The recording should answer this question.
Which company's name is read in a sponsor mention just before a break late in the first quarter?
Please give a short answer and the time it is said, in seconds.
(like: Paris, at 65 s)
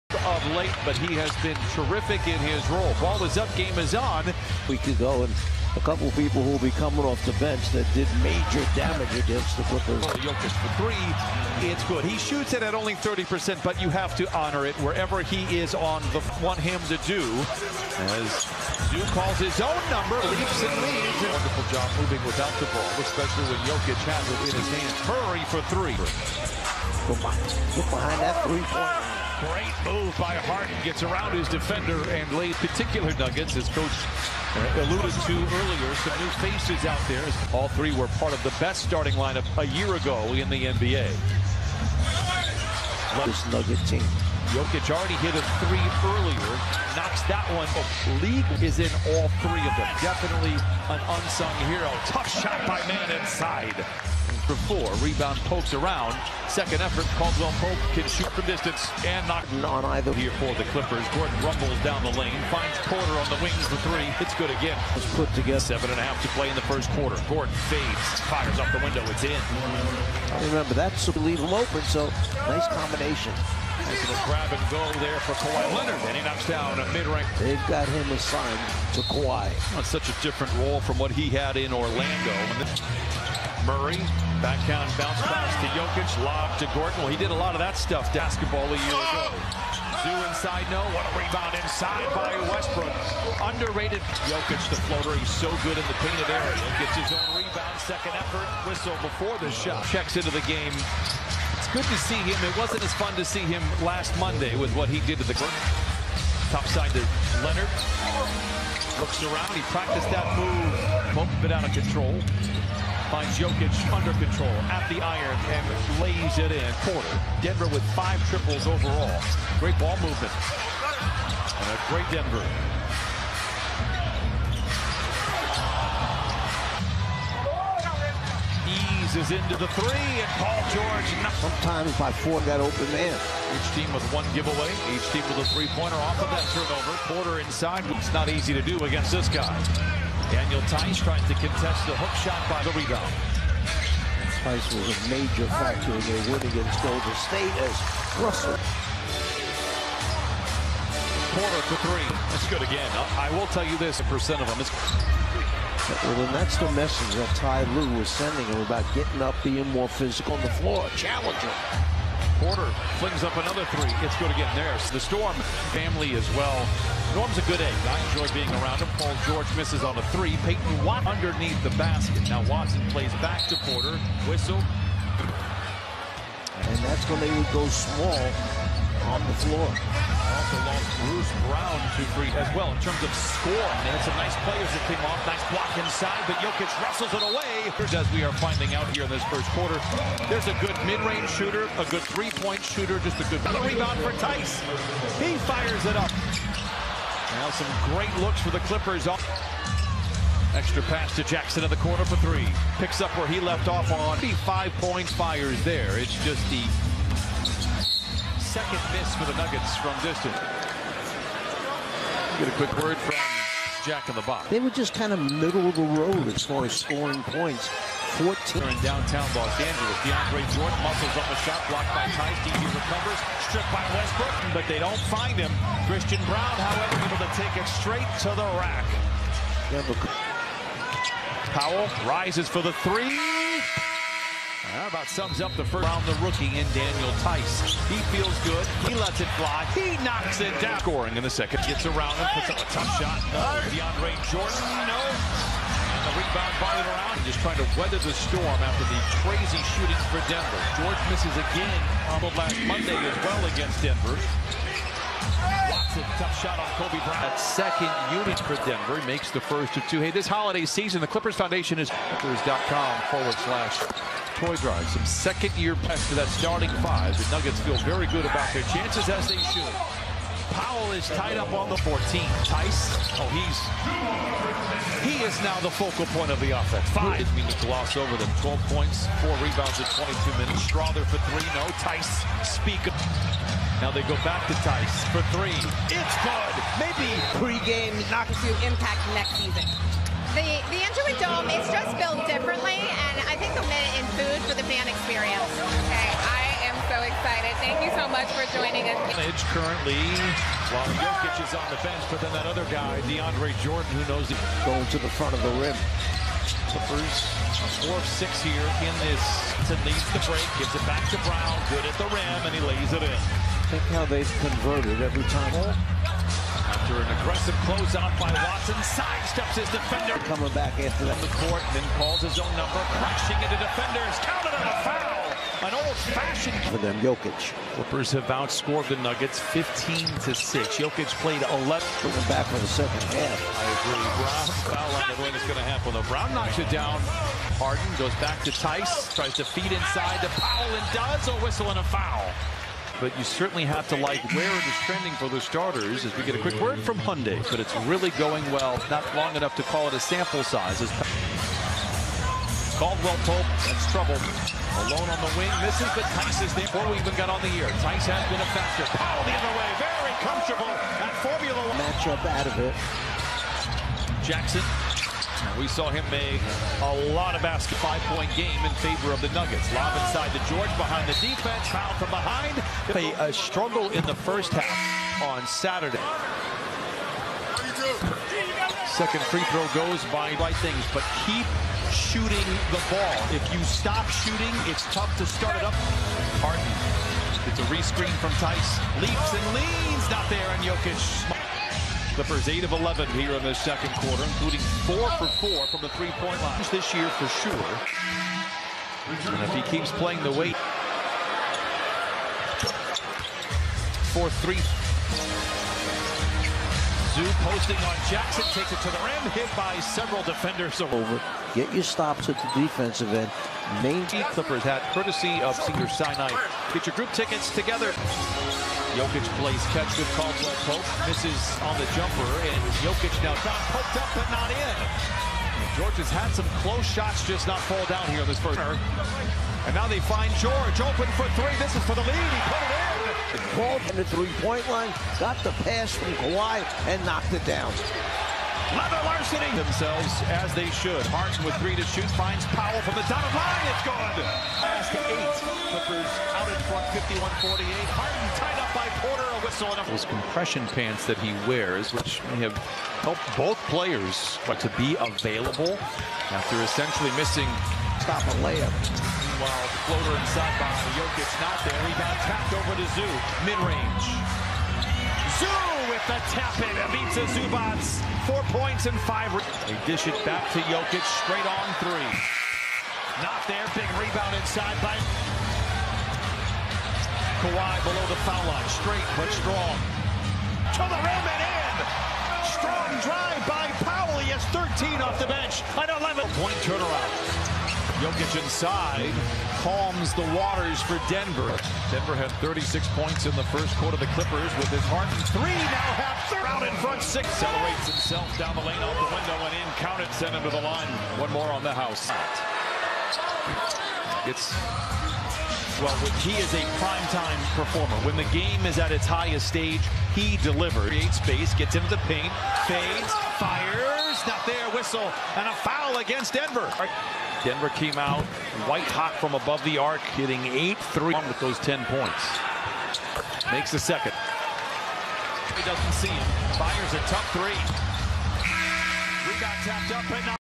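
Jack in the box, at 213 s.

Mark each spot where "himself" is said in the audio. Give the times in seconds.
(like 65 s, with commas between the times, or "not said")
497 s.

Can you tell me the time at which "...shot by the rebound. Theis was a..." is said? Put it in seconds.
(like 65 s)
142 s.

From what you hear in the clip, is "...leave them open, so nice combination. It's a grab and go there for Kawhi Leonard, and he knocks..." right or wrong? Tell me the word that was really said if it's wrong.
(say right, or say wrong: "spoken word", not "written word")
right.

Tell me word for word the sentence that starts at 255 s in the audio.
Watson, tough shot on Kobe Bryant.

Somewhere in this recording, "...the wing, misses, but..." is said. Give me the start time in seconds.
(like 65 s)
355 s.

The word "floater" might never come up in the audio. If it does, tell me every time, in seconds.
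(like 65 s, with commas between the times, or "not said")
94 s, 459 s.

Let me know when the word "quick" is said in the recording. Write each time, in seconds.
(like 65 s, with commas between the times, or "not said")
212 s, 346 s.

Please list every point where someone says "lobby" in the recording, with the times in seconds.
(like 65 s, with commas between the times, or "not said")
not said.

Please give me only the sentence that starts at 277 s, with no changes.
Didn't mean to gloss over them.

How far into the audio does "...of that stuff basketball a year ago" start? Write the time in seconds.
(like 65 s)
87 s.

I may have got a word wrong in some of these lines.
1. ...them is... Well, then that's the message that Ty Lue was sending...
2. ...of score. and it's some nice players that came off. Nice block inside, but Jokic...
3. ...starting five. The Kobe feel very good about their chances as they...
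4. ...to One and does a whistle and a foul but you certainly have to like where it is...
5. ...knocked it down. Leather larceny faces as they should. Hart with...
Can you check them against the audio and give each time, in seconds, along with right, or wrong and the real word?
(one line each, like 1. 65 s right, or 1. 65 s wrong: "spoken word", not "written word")
1. 154 s right
2. 183 s right
3. 266 s wrong: "Nuggets", not "Kobe"
4. 340 s wrong: "Powell", not "One"
5. 437 s wrong: "themselves", not "faces".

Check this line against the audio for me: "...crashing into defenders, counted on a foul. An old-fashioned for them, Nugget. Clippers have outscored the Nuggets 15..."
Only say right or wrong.
wrong.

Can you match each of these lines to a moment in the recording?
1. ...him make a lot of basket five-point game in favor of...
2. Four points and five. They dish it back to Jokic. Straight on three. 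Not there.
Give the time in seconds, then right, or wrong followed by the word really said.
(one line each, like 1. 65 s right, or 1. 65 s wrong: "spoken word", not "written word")
1. 365 s right
2. 468 s right.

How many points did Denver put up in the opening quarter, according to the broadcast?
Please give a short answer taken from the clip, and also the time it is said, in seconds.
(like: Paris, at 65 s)
36, at 492 s.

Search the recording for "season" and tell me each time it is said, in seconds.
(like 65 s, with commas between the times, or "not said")
260 s, 289 s.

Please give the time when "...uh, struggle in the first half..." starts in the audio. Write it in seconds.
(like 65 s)
373 s.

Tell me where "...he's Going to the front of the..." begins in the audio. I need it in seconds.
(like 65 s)
304 s.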